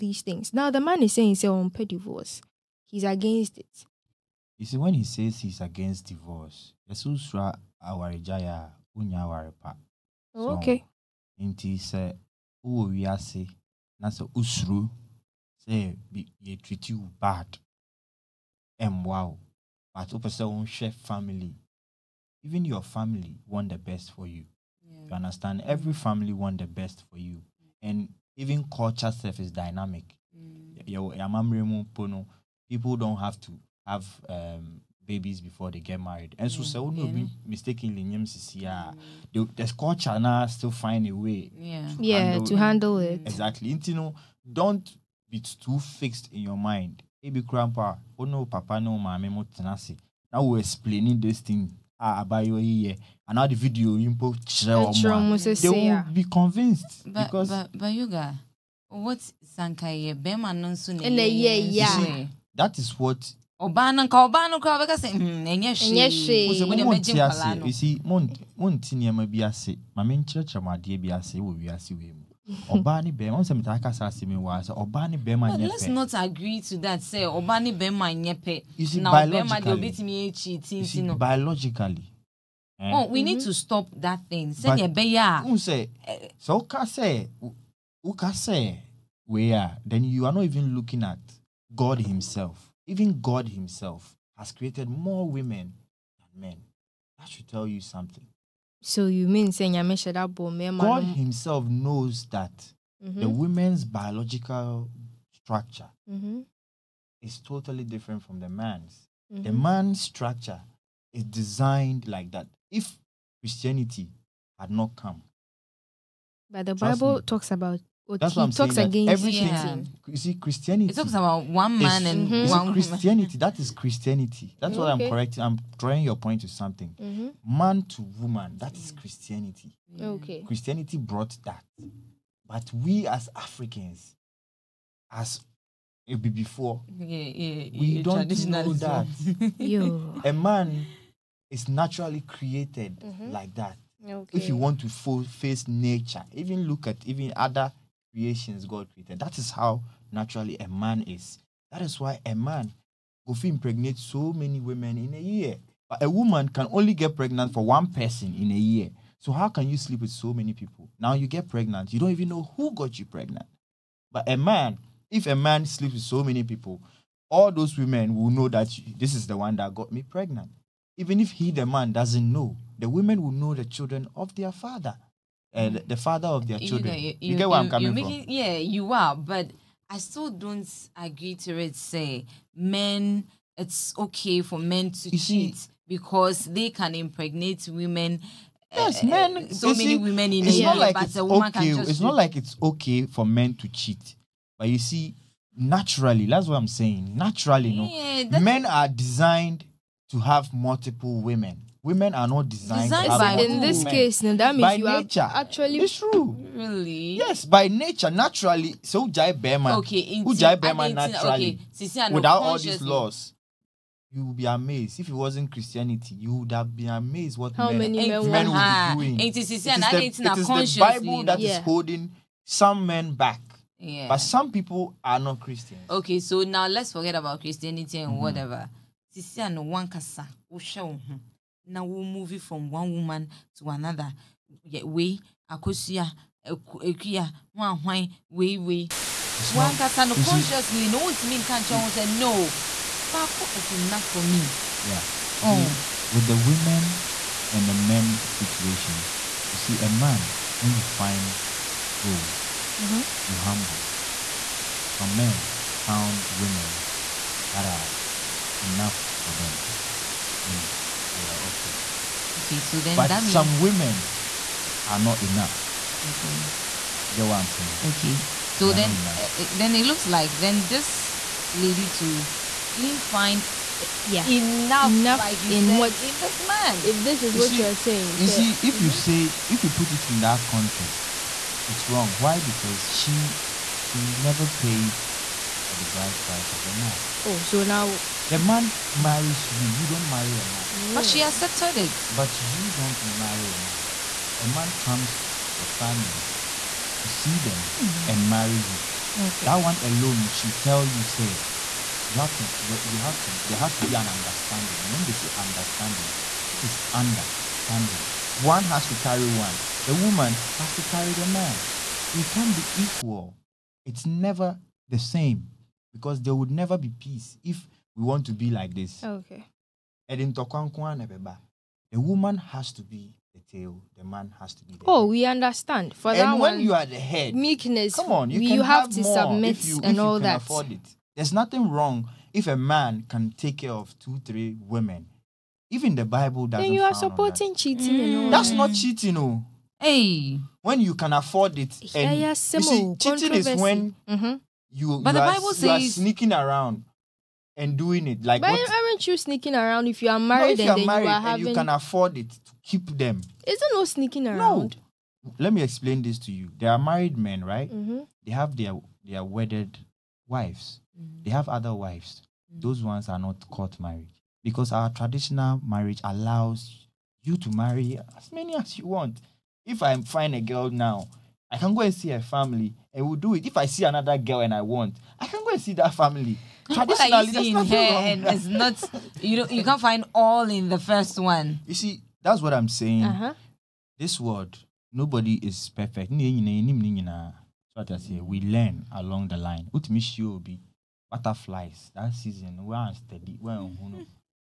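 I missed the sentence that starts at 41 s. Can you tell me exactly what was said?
Yeah, to yeah, handle to handle it.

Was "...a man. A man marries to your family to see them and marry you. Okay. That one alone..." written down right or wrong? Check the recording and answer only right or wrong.
wrong.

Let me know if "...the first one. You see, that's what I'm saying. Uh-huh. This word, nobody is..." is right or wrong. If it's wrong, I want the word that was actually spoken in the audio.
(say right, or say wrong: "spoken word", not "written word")
right.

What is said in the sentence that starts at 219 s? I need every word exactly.
It is, it is, the, it is the Bible that yeah.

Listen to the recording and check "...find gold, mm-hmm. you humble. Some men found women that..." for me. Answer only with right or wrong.
right.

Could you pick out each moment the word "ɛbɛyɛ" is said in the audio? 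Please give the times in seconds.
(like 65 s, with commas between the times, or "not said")
84 s.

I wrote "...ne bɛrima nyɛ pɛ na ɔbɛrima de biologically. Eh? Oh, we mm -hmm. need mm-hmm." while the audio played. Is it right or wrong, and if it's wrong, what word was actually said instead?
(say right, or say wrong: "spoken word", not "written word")
right.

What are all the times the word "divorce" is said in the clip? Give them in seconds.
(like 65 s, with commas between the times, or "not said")
1 s, 6 s.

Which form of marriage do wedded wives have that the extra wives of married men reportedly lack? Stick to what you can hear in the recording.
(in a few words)
court marriage.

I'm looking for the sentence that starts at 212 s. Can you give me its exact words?
without all these laws you would be amazed if it wasn't Christianity.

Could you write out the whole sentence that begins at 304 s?
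And when they say understanding, this is understanding.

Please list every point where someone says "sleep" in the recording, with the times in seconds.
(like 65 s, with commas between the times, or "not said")
159 s, 165 s.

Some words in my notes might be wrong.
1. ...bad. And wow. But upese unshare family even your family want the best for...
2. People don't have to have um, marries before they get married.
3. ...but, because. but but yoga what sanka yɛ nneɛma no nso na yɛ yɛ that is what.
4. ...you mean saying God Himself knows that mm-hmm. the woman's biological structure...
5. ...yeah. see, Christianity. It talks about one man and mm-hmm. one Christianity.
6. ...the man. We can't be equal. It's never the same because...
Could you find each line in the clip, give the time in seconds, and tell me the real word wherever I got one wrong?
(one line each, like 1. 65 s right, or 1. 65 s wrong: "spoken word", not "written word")
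1. 17 s right
2. 32 s wrong: "babies", not "marries"
3. 57 s wrong: "bɛrima", not "nneɛma"
4. 99 s right
5. 120 s right
6. 311 s right.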